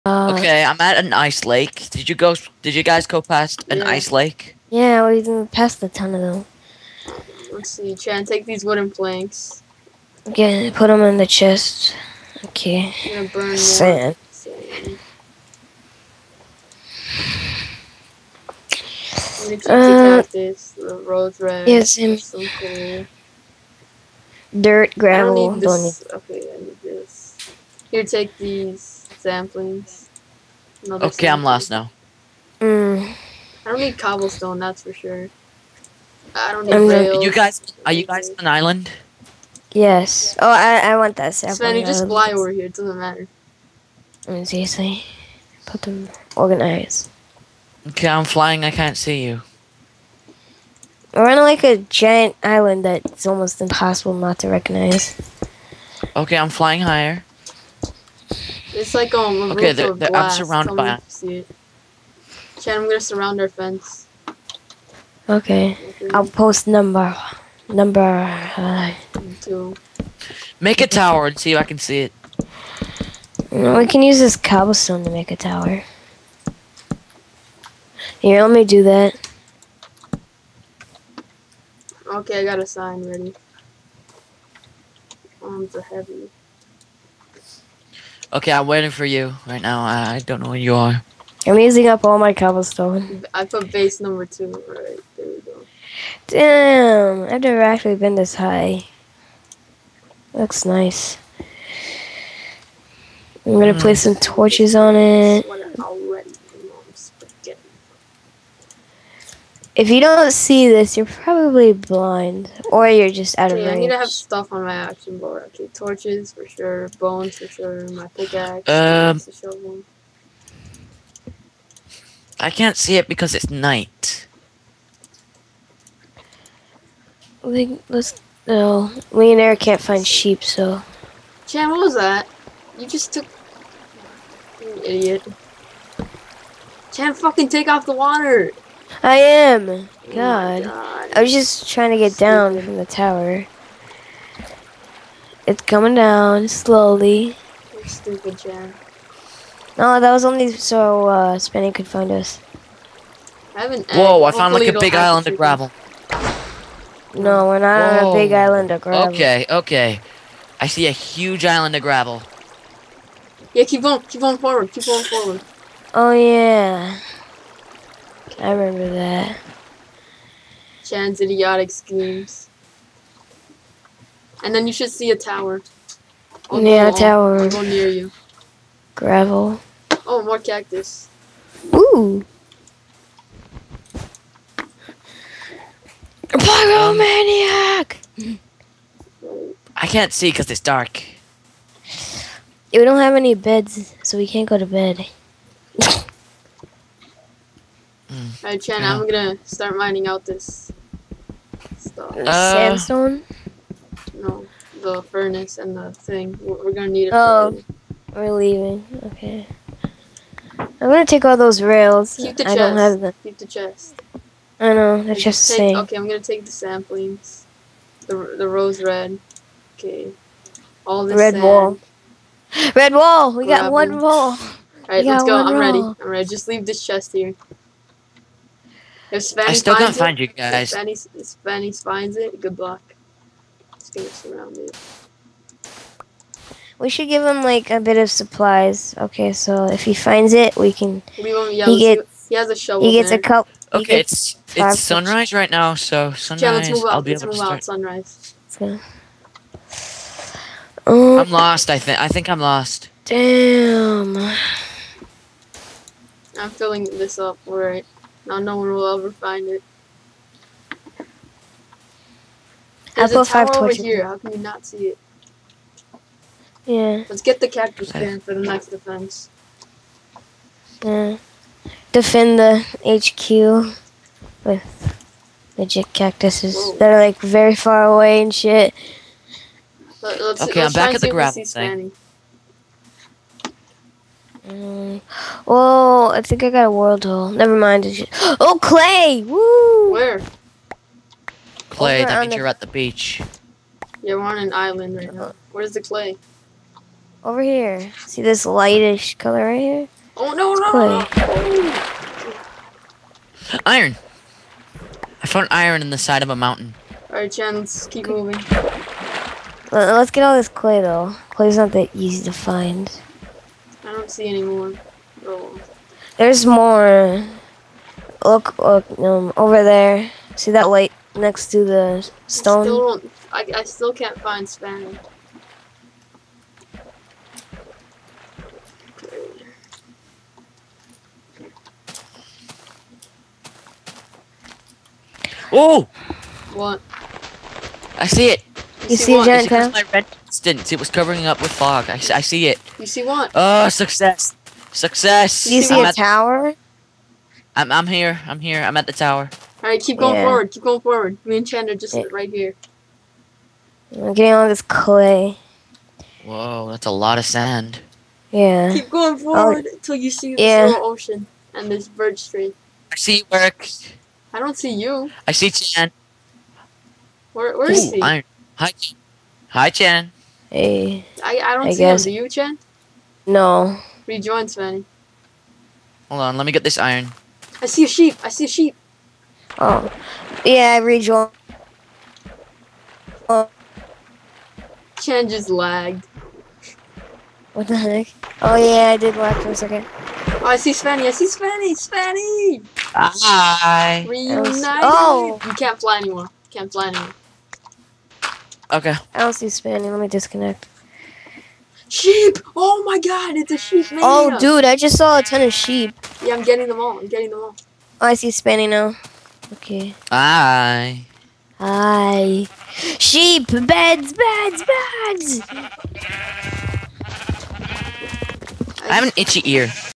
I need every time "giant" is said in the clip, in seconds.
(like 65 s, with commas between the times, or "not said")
51 s, 339 s.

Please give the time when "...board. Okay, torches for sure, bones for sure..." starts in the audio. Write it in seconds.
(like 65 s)
115 s.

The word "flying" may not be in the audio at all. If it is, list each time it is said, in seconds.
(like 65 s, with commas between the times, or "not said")
48 s, 56 s.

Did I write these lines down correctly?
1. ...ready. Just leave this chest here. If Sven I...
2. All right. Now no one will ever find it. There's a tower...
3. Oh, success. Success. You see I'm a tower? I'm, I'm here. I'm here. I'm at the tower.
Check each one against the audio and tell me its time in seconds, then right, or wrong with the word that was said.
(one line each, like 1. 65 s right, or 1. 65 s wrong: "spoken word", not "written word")
1. 226 s right
2. 257 s right
3. 343 s right.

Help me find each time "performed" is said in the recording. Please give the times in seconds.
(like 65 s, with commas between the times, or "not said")
not said.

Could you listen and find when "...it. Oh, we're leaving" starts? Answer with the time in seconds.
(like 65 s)
207 s.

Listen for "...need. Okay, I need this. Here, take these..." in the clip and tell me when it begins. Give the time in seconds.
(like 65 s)
25 s.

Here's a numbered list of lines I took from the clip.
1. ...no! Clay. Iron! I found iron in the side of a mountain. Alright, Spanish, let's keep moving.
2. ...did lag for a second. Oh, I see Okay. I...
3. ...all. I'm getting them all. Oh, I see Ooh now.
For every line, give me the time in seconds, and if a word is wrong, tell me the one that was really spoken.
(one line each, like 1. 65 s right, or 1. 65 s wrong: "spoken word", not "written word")
1. 300 s wrong: "Chan", not "Spanish"
2. 388 s wrong: "Spanny", not "Okay"
3. 406 s wrong: "Spanny", not "Ooh".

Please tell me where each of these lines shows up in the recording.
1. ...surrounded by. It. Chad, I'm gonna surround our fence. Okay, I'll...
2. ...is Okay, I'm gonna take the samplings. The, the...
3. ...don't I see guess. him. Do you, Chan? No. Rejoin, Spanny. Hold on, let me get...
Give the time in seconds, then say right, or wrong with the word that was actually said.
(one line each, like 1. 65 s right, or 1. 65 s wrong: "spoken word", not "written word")
1. 60 s right
2. 215 s right
3. 371 s right.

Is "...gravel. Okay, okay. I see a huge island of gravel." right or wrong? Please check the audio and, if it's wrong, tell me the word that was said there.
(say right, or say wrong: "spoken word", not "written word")
right.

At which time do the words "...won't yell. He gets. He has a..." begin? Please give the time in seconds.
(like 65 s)
241 s.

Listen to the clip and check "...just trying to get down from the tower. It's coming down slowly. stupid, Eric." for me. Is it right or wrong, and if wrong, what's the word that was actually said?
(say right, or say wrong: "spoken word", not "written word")
wrong: "John", not "Eric".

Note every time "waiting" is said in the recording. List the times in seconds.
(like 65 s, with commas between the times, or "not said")
88 s.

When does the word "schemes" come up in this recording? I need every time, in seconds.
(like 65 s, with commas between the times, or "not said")
171 s.